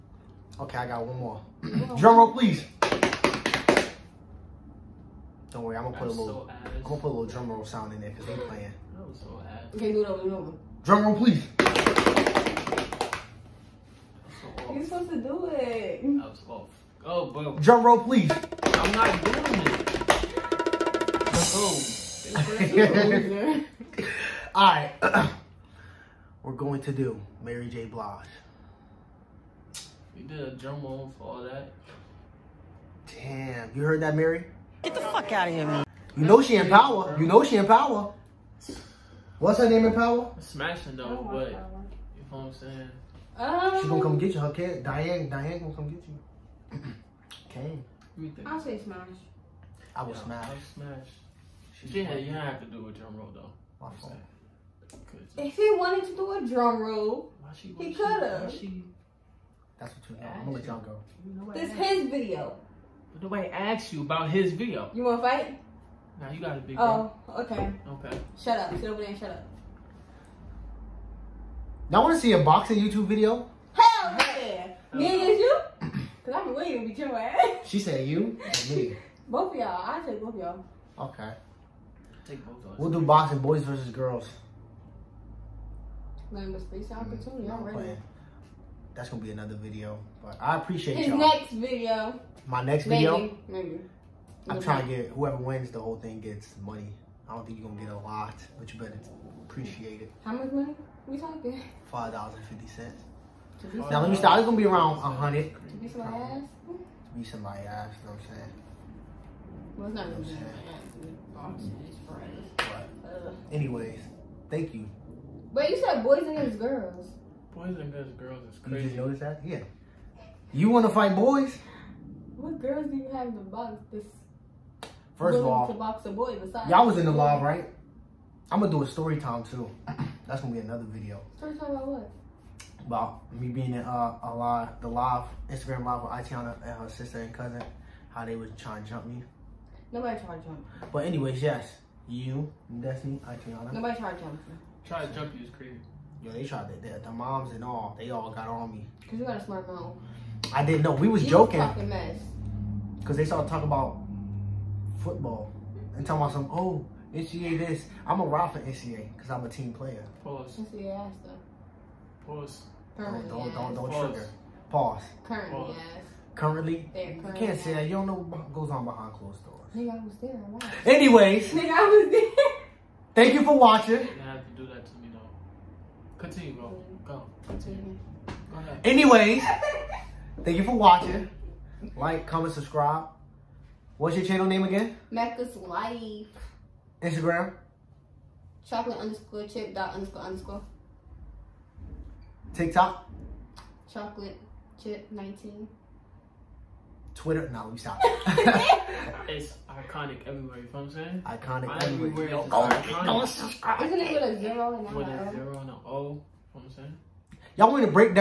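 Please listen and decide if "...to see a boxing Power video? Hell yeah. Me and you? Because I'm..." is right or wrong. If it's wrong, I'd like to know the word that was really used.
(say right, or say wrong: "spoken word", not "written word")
wrong: "YouTube", not "Power".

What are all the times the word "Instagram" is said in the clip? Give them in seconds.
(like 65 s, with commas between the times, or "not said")
135 s, 187 s.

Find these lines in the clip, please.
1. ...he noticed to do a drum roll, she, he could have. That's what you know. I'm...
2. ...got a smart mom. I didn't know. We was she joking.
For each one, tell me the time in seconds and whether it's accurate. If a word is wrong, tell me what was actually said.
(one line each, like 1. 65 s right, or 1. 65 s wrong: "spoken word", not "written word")
1. 55 s wrong: "wanted", not "noticed"
2. 149 s right.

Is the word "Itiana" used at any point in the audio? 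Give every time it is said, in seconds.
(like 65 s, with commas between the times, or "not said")
136 s, 143 s.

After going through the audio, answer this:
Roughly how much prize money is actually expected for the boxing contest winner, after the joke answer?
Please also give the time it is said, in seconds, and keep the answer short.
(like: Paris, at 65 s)
100, at 104 s.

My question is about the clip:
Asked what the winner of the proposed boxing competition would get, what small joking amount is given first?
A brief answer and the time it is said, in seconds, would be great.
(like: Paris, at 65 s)
$5.50, at 101 s.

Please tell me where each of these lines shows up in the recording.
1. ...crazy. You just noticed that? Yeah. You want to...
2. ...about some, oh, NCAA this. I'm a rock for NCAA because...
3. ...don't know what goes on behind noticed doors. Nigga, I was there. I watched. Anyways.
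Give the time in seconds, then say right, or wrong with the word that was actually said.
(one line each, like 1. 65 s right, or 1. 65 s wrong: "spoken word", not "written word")
1. 118 s right
2. 156 s right
3. 167 s wrong: "closed", not "noticed".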